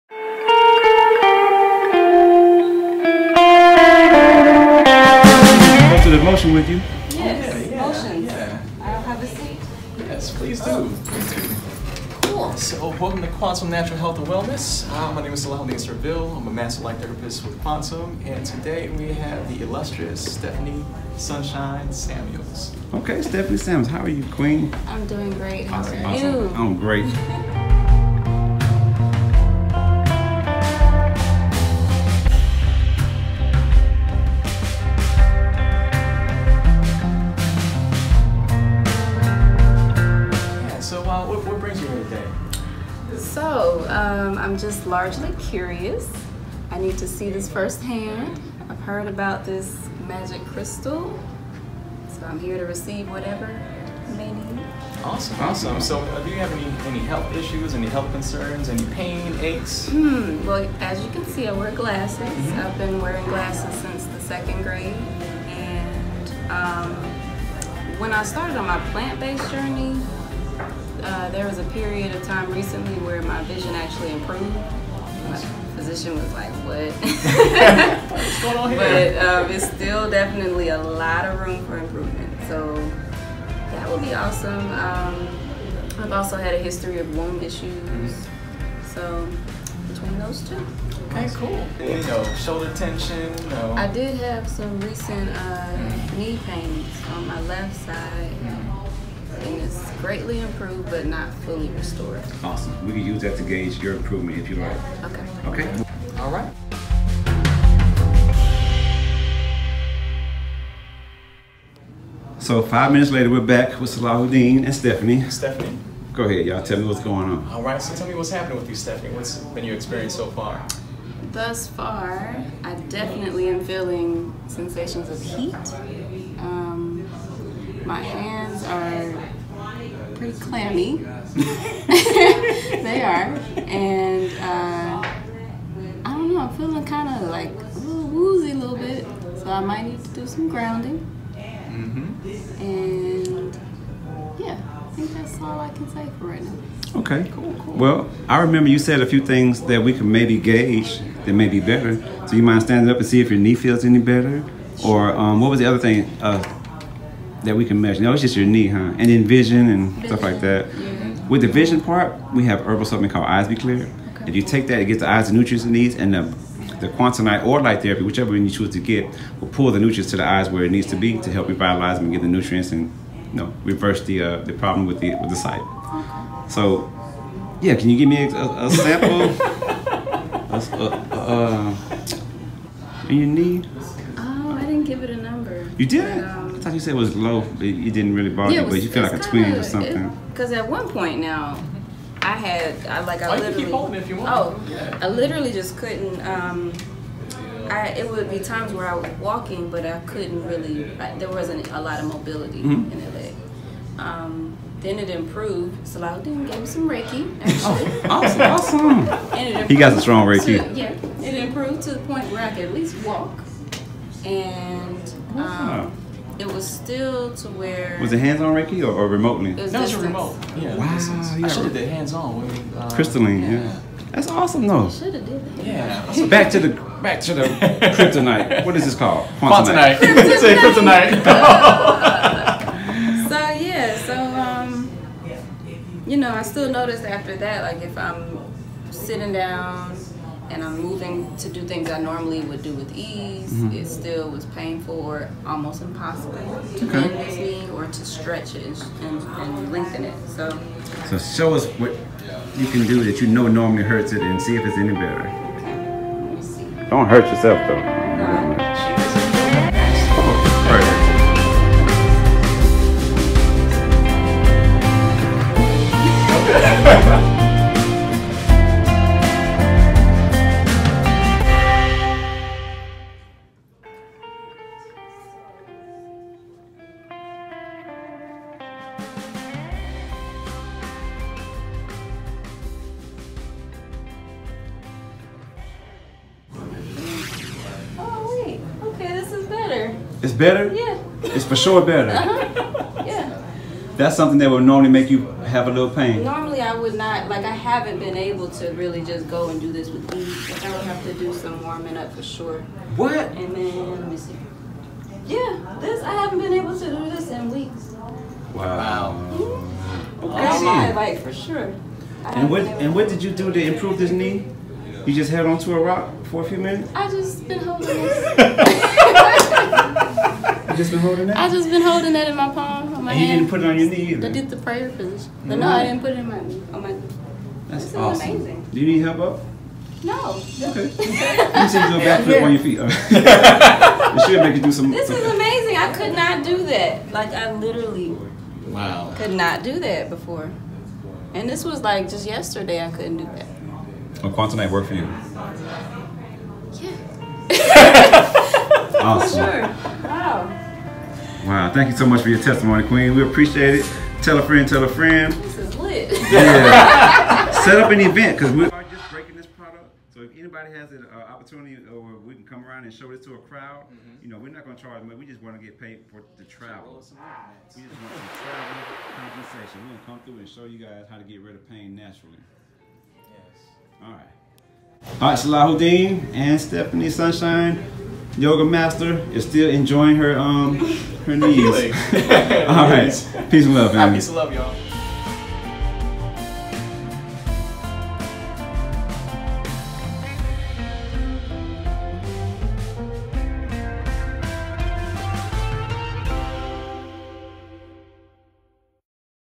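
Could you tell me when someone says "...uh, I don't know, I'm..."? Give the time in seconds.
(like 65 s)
134 s.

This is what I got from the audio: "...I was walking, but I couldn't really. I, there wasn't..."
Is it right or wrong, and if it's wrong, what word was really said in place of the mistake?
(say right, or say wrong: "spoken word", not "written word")
right.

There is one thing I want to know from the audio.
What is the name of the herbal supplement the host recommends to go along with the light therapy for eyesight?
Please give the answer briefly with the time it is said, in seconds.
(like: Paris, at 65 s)
Eyes Be Clear, at 163 s.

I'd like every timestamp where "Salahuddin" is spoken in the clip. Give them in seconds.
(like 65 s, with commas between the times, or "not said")
15 s, 113 s, 205 s, 375 s.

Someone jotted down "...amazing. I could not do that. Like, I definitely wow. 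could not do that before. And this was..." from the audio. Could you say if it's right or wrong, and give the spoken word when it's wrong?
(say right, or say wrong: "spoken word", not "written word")
wrong: "literally", not "definitely".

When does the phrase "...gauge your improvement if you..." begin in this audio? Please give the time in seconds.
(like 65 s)
103 s.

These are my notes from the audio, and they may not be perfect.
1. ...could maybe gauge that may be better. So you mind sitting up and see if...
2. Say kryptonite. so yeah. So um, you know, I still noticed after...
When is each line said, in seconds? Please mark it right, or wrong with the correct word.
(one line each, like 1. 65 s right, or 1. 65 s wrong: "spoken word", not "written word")
1. 149 s wrong: "standing", not "sitting"
2. 230 s right.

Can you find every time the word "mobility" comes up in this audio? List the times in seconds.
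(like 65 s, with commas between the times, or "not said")
202 s.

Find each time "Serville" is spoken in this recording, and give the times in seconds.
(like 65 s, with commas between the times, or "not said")
15 s.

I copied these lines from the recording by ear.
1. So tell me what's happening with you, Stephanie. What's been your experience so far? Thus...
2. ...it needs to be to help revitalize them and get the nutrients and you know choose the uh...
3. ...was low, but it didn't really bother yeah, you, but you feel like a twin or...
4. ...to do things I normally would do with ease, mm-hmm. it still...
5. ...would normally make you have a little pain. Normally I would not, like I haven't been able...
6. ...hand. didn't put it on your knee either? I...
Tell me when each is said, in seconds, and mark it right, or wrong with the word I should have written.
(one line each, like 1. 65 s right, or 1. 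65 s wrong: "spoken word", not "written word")
1. 117 s right
2. 170 s wrong: "reverse", not "choose"
3. 186 s right
4. 241 s right
5. 294 s right
6. 323 s right.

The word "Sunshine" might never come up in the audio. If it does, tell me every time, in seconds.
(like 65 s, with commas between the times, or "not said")
21 s, 377 s.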